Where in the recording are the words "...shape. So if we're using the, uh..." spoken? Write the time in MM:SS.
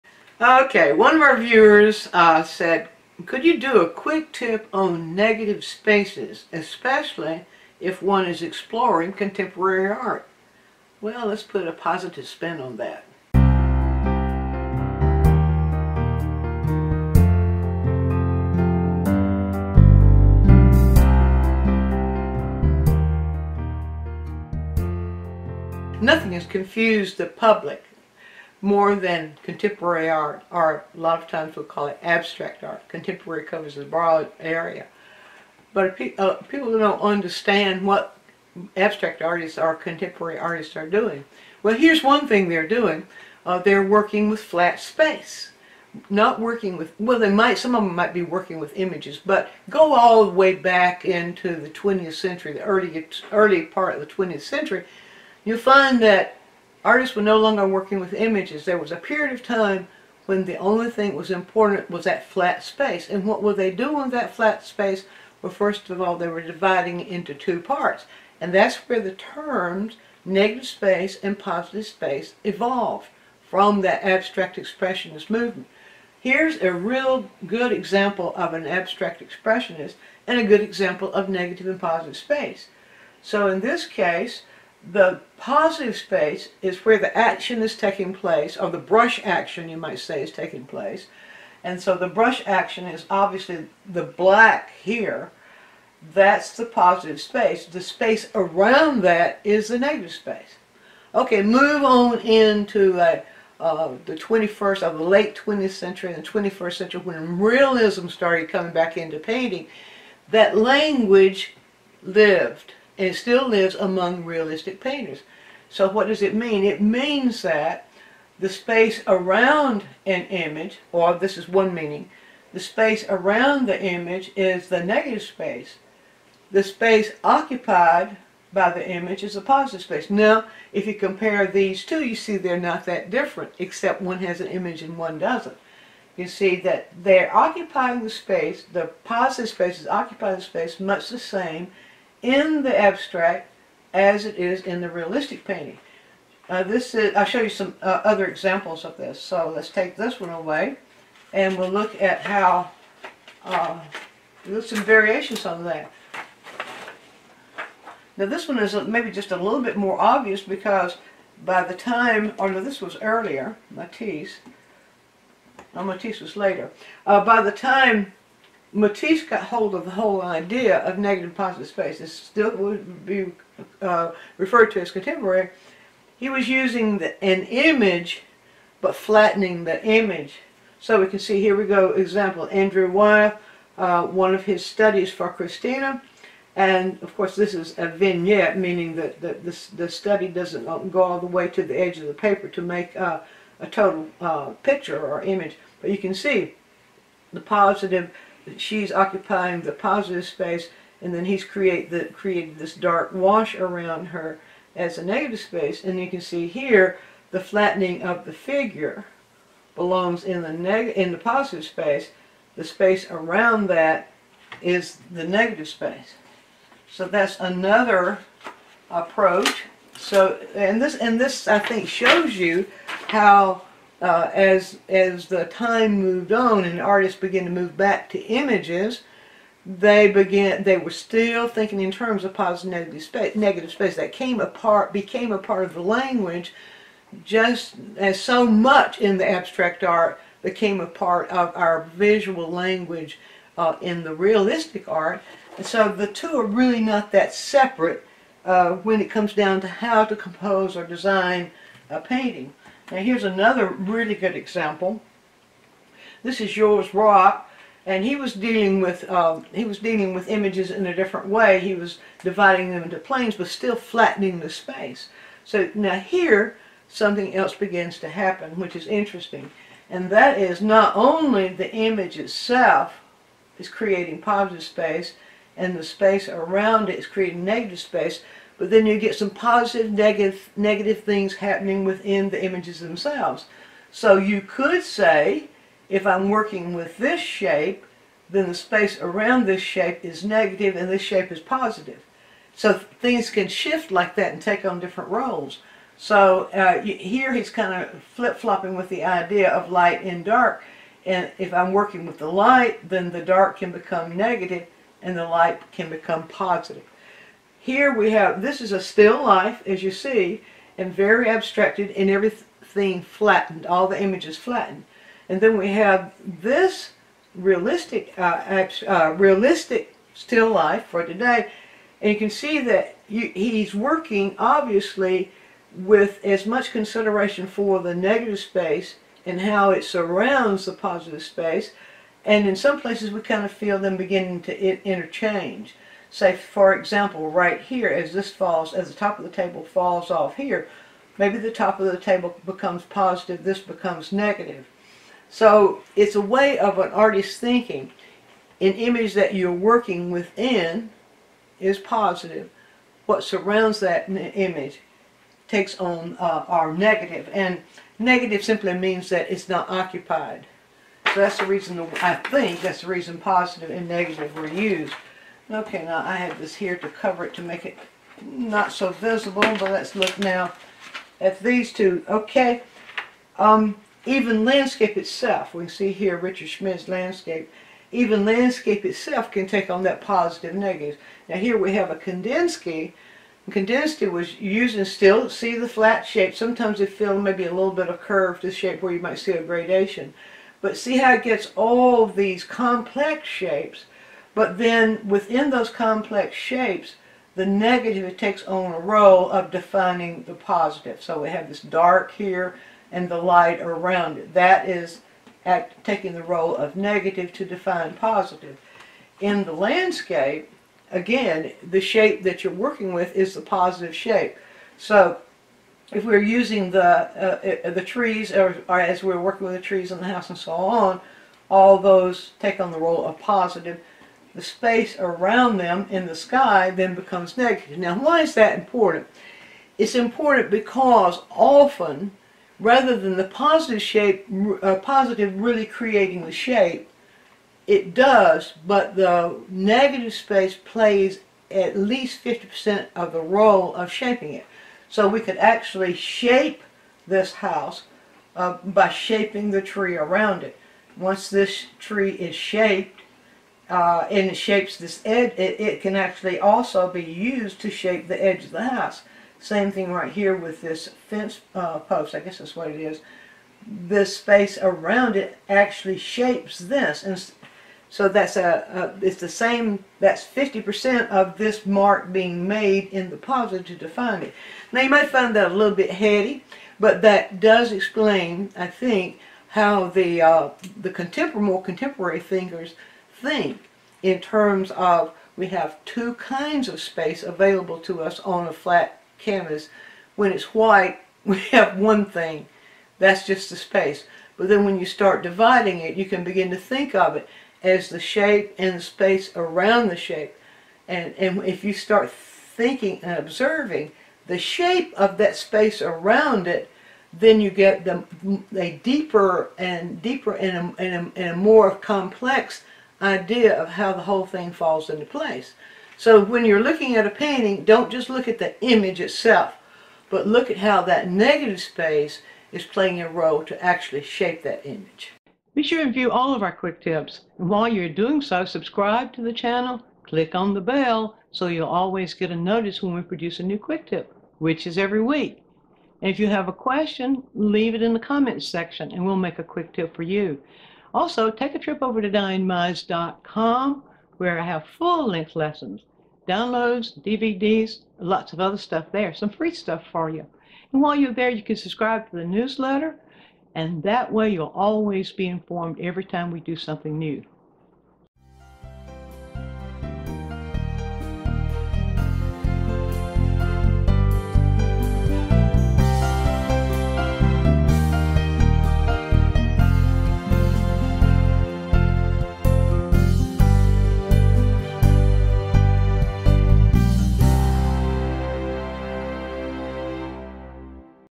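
06:53.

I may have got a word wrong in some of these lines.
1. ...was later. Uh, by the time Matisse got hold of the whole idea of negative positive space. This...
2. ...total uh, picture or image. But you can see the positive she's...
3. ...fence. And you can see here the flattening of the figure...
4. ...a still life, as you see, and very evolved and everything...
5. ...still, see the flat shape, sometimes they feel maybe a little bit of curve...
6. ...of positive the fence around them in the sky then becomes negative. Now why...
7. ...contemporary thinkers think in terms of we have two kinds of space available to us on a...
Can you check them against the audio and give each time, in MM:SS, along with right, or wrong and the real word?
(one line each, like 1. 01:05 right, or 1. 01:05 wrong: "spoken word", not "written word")
1. 02:46 right
2. 03:13 right
3. 03:25 wrong: "space", not "fence"
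4. 05:08 wrong: "abstracted", not "evolved"
5. 06:24 right
6. 07:03 wrong: "space", not "fence"
7. 08:01 right.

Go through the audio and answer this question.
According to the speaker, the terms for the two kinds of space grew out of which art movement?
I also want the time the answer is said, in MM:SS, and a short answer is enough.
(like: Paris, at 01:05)
Abstract expressionist movement, at 01:14.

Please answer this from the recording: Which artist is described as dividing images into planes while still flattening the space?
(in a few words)
Georges Braque.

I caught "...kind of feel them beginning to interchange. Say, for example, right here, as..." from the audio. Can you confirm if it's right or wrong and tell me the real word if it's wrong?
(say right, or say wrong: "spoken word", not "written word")
right.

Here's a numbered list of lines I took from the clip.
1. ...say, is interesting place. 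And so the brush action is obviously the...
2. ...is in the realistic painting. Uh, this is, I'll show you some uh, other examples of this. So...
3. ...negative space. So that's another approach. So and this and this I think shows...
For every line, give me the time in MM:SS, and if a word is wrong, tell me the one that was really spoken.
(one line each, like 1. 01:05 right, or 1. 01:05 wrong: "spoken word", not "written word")
1. 01:29 wrong: "taking", not "interesting"
2. 02:24 right
3. 03:35 right.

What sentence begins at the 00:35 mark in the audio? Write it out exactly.
But uh, people don't understand what abstract artists or contemporary artists are doing.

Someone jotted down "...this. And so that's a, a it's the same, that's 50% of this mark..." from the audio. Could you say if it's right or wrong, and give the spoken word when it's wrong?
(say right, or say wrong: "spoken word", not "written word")
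right.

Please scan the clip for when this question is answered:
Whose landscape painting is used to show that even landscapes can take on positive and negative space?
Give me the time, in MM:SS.
06:16.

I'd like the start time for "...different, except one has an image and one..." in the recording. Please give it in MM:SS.
02:13.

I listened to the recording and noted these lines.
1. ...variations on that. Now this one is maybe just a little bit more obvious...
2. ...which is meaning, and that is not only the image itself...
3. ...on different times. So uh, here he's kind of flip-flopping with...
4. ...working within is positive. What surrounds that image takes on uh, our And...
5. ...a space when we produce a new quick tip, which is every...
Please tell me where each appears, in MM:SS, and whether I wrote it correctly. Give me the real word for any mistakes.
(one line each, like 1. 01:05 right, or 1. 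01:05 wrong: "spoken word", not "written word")
1. 02:34 right
2. 04:28 wrong: "interesting", not "meaning"
3. 04:54 wrong: "roles", not "times"
4. 05:49 right
5. 08:52 wrong: "notice", not "space".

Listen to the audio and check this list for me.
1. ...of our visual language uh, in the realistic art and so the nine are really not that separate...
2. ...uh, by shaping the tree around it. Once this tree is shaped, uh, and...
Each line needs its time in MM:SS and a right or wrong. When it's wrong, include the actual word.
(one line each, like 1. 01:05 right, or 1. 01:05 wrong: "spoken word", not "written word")
1. 04:01 wrong: "two", not "nine"
2. 07:28 right.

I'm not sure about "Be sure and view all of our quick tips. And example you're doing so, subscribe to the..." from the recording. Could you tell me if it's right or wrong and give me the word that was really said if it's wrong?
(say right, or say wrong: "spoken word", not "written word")
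wrong: "while", not "example".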